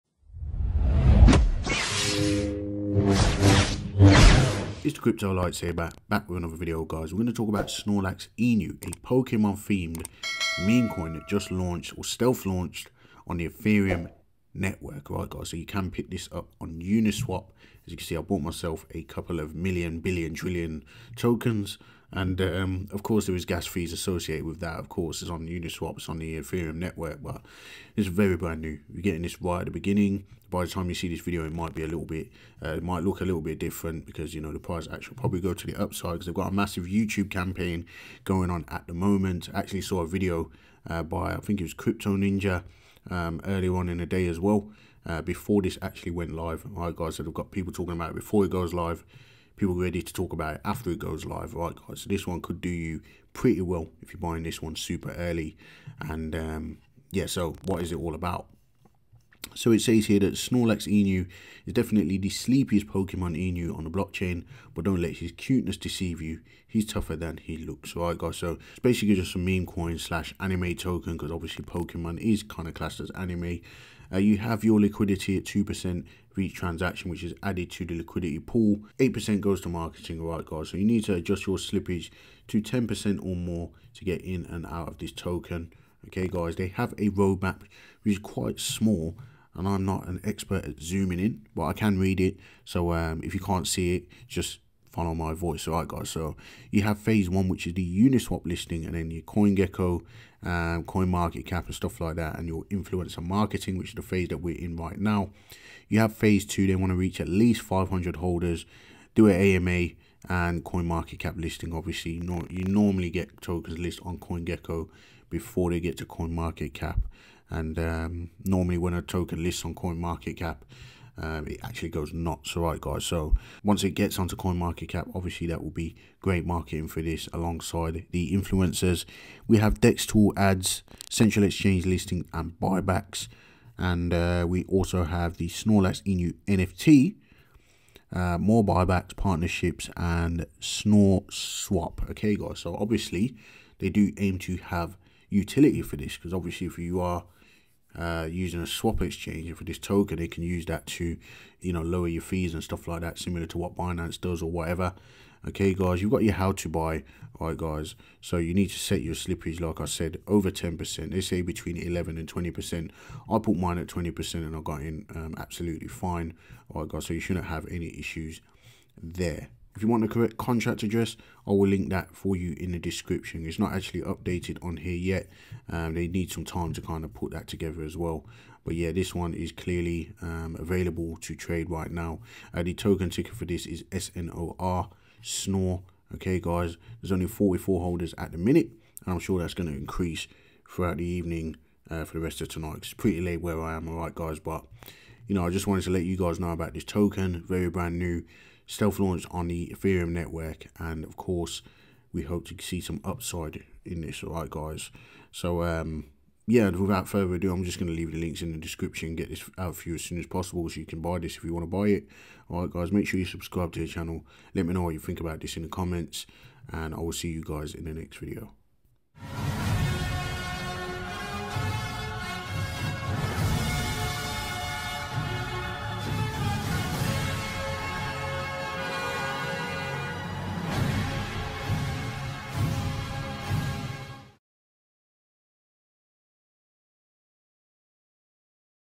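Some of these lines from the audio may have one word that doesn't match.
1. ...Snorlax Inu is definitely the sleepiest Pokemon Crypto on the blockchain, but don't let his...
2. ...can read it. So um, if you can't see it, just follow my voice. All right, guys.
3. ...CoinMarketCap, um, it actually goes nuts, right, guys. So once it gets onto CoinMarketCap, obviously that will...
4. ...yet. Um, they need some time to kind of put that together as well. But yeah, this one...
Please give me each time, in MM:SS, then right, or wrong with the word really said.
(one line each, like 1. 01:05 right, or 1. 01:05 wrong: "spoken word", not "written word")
1. 01:00 wrong: "Inu", not "Crypto"
2. 01:31 right
3. 01:59 right
4. 02:54 right.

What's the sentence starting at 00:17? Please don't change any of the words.
As you can see, I bought myself a couple of million, billion, trillion tokens.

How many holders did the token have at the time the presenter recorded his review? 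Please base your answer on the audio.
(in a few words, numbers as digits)
44.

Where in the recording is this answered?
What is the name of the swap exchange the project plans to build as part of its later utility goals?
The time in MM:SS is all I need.
02:20.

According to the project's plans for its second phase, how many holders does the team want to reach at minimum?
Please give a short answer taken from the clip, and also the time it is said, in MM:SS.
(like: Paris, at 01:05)
500, at 01:47.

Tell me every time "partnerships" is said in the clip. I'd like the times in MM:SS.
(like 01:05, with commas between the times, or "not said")
02:19.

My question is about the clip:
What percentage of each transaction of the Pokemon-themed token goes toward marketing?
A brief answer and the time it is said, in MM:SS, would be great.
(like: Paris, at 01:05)
8%, at 01:18.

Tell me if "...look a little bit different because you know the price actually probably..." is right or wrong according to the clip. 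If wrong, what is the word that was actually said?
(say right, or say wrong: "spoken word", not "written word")
right.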